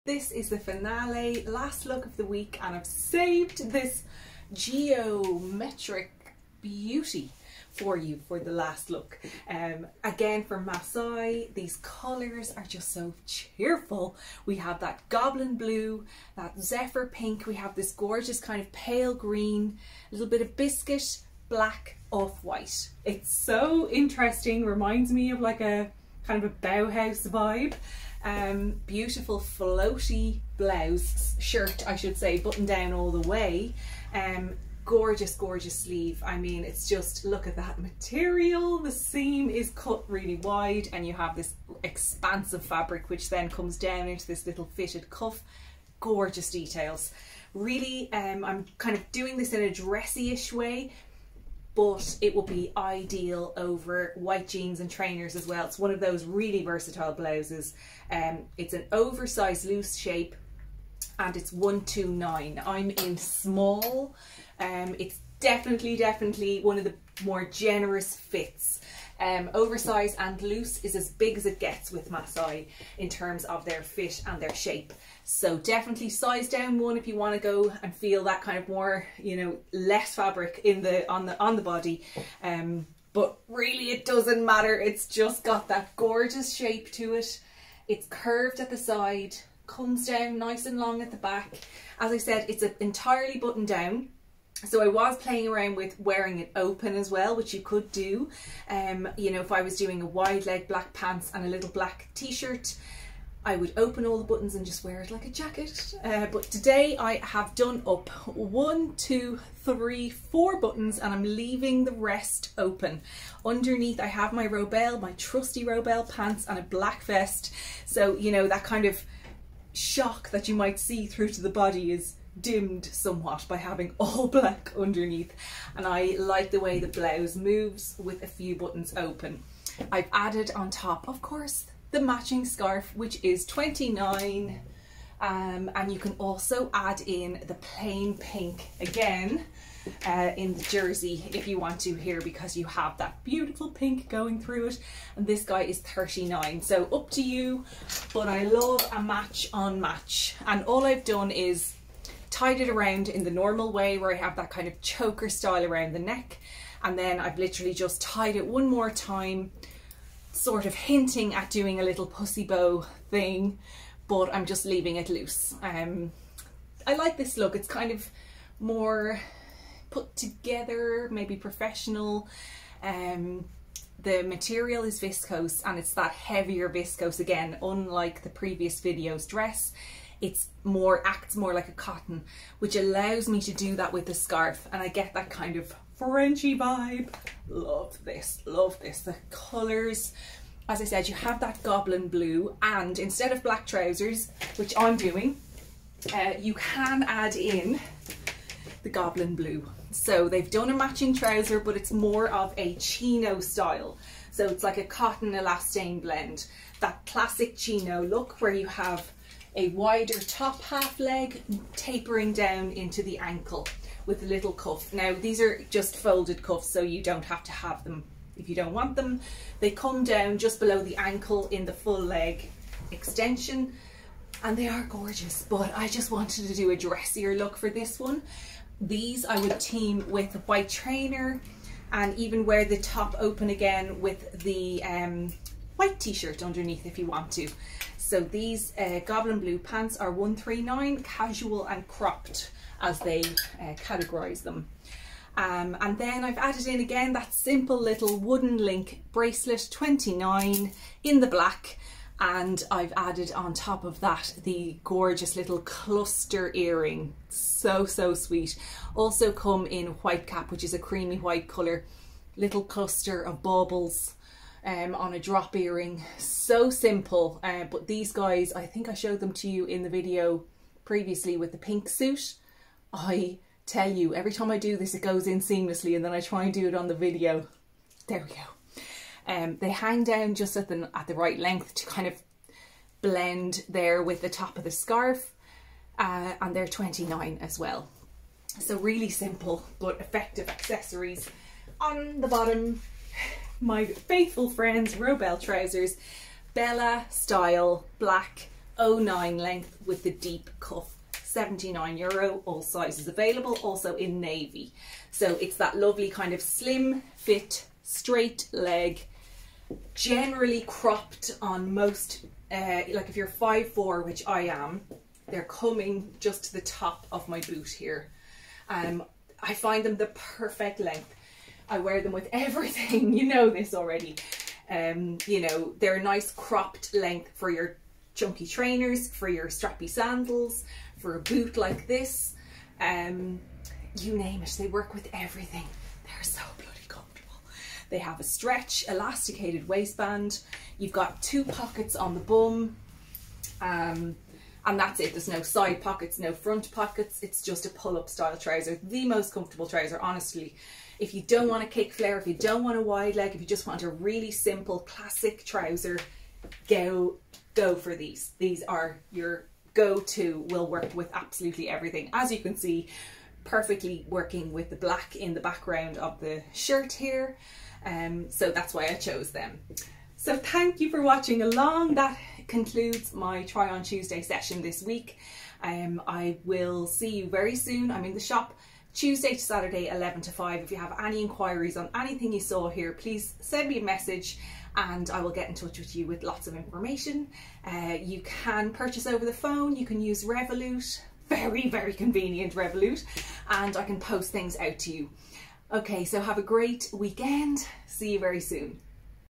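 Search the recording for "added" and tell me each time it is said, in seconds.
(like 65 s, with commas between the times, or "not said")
130 s, 246 s, 252 s.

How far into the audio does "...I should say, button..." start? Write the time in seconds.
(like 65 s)
31 s.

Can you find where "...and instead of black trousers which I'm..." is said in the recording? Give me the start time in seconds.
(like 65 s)
192 s.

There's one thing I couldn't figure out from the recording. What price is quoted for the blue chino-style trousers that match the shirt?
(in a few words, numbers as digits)
139.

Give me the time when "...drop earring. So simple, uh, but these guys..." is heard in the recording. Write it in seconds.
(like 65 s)
265 s.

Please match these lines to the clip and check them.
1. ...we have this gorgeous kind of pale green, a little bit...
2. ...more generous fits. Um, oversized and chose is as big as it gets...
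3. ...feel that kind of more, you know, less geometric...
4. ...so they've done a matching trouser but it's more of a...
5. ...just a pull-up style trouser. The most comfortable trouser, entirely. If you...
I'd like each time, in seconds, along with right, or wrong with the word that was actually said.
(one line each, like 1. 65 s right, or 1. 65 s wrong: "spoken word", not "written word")
1. 17 s right
2. 67 s wrong: "loose", not "chose"
3. 77 s wrong: "fabric", not "geometric"
4. 199 s right
5. 347 s wrong: "honestly", not "entirely".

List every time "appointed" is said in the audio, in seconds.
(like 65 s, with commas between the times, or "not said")
not said.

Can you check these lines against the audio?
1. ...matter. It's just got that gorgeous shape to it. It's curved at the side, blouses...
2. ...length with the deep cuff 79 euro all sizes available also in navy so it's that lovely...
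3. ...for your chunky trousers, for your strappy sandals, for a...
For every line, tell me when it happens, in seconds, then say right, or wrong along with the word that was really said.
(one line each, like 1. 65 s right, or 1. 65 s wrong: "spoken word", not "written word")
1. 84 s wrong: "comes", not "blouses"
2. 299 s right
3. 327 s wrong: "trainers", not "trousers".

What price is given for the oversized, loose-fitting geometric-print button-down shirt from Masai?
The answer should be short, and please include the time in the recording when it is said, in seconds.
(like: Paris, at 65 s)
129, at 61 s.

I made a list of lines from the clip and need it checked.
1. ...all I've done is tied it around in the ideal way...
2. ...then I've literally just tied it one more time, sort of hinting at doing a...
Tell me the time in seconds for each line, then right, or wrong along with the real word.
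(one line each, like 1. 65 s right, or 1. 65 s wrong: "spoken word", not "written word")
1. 150 s wrong: "normal", not "ideal"
2. 156 s right.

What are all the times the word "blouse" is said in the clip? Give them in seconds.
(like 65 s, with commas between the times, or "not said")
30 s, 57 s, 126 s.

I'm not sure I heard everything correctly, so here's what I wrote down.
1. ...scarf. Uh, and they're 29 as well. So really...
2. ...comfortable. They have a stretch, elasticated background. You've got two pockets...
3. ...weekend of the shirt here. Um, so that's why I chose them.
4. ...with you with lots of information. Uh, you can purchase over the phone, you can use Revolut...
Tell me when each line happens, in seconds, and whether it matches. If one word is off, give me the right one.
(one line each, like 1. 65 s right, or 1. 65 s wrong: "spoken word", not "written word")
1. 284 s right
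2. 336 s wrong: "waistband", not "background"
3. 365 s wrong: "background", not "weekend"
4. 385 s right.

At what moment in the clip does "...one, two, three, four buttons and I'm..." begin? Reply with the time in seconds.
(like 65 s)
108 s.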